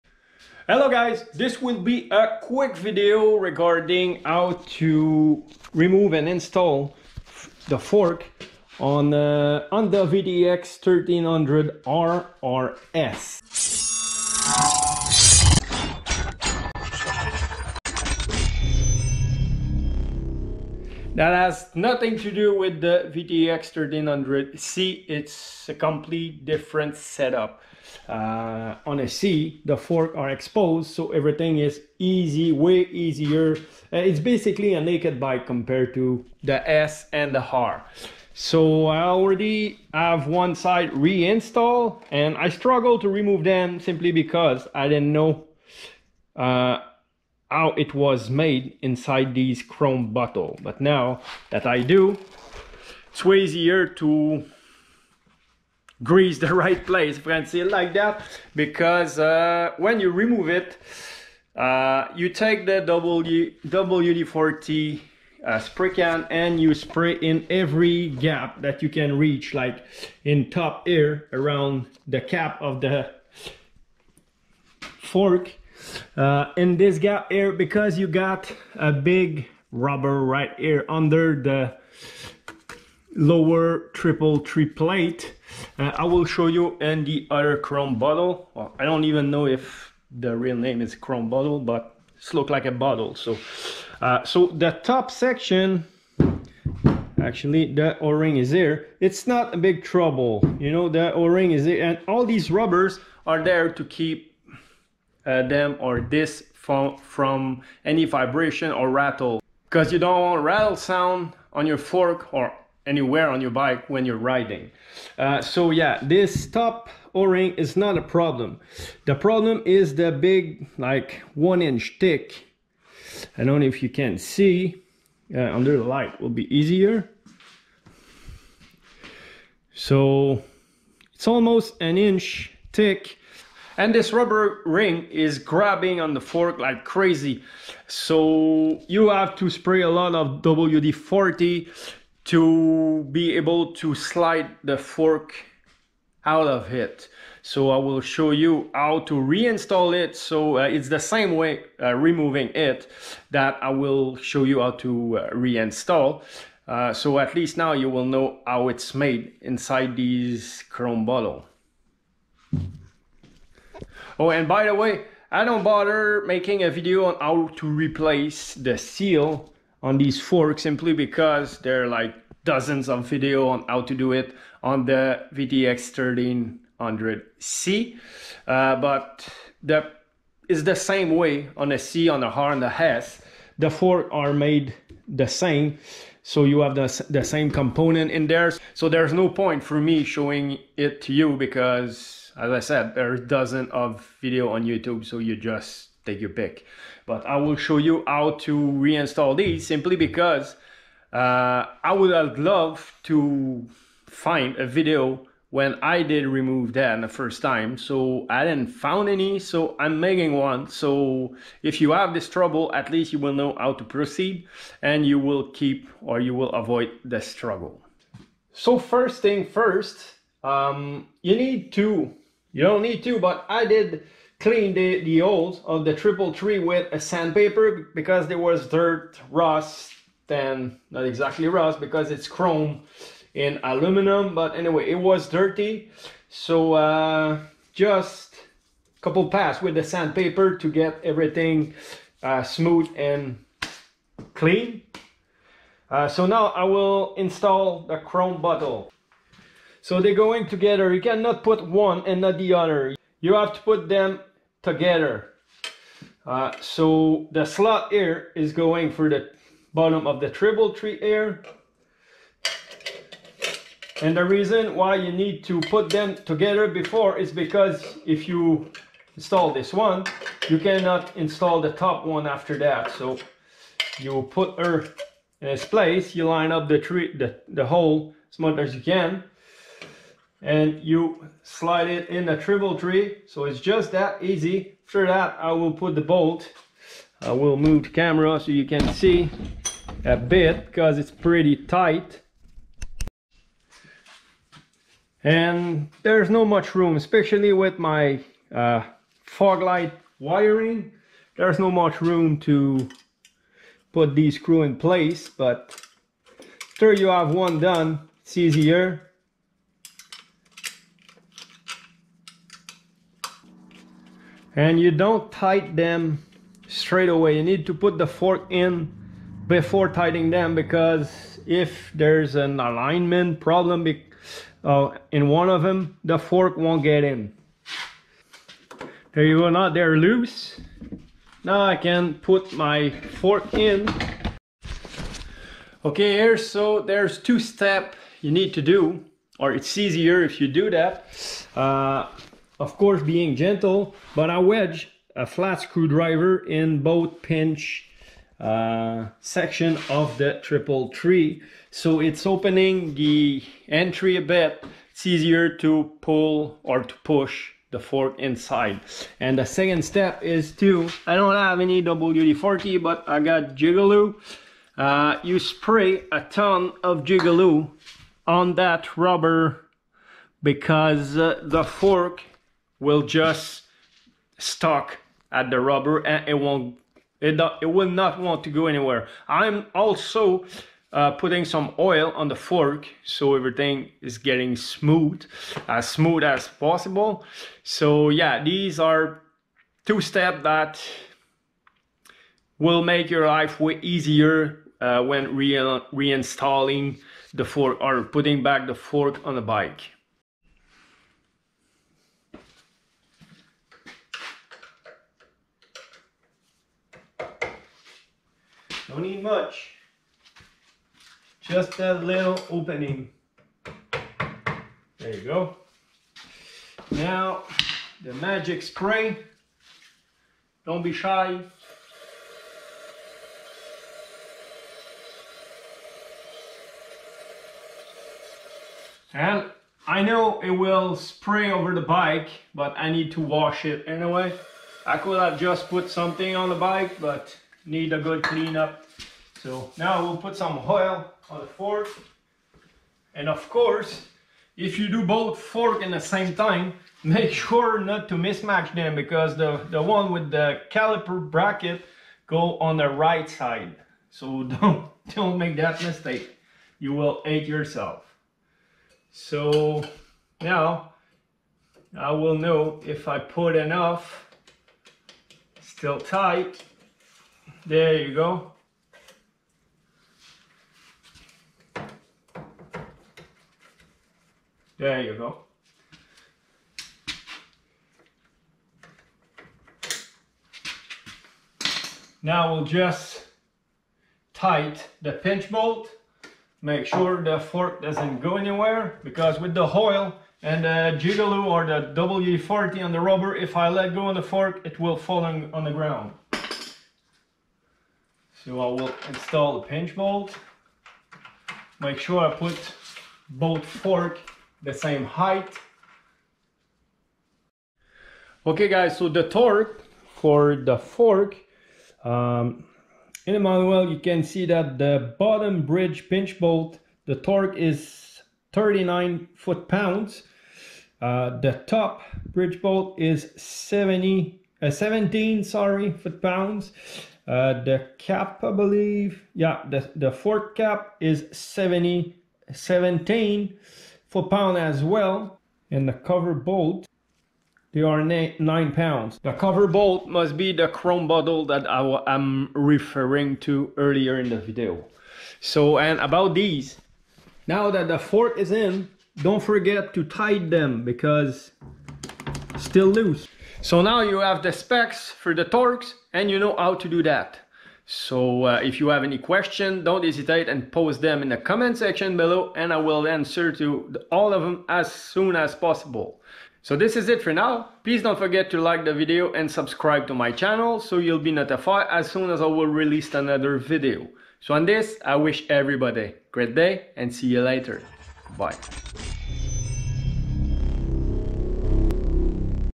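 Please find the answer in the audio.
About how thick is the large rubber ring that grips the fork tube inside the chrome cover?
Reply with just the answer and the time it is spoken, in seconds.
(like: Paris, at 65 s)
almost an inch, at 131 s.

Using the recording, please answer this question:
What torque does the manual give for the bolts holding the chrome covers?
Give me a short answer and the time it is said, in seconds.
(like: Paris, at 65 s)
9 pounds, at 538 s.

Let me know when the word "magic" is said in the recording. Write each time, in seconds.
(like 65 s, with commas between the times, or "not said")
418 s.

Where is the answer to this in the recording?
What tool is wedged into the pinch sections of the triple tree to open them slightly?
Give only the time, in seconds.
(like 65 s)
345 s.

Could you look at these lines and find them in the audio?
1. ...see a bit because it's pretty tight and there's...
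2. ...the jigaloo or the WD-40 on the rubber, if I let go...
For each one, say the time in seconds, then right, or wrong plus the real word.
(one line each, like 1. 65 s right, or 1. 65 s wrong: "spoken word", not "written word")
1. 288 s right
2. 490 s right.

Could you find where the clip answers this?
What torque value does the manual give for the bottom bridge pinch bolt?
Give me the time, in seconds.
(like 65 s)
518 s.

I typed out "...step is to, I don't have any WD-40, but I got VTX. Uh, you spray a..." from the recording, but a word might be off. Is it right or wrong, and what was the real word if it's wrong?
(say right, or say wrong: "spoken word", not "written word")
wrong: "Jigaloo", not "VTX".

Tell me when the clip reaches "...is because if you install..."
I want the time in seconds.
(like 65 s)
267 s.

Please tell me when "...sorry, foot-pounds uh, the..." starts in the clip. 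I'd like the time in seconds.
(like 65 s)
525 s.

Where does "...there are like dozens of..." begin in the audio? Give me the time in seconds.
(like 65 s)
171 s.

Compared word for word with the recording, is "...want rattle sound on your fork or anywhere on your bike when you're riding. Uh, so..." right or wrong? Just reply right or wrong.
right.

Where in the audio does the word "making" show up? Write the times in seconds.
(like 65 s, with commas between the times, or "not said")
166 s, 209 s.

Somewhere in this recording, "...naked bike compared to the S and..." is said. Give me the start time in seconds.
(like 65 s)
34 s.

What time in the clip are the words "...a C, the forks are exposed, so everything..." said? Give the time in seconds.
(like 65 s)
29 s.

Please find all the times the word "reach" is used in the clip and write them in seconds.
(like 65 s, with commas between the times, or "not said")
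69 s.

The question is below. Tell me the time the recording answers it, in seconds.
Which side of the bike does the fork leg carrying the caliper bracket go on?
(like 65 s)
452 s.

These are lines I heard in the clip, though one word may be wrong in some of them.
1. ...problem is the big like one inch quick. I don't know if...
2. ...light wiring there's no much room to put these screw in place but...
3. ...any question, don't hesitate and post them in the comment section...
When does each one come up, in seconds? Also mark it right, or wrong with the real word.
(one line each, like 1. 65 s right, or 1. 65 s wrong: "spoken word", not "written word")
1. 119 s wrong: "thick", not "quick"
2. 299 s right
3. 559 s right.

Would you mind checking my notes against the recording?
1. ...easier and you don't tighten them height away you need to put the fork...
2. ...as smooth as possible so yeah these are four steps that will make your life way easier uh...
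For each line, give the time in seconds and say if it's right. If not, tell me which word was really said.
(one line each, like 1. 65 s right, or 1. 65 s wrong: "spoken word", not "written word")
1. 308 s wrong: "straight", not "height"
2. 385 s wrong: "two", not "four".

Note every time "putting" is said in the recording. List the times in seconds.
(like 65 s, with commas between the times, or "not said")
381 s, 398 s.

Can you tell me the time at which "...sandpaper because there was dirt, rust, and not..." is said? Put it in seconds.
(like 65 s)
226 s.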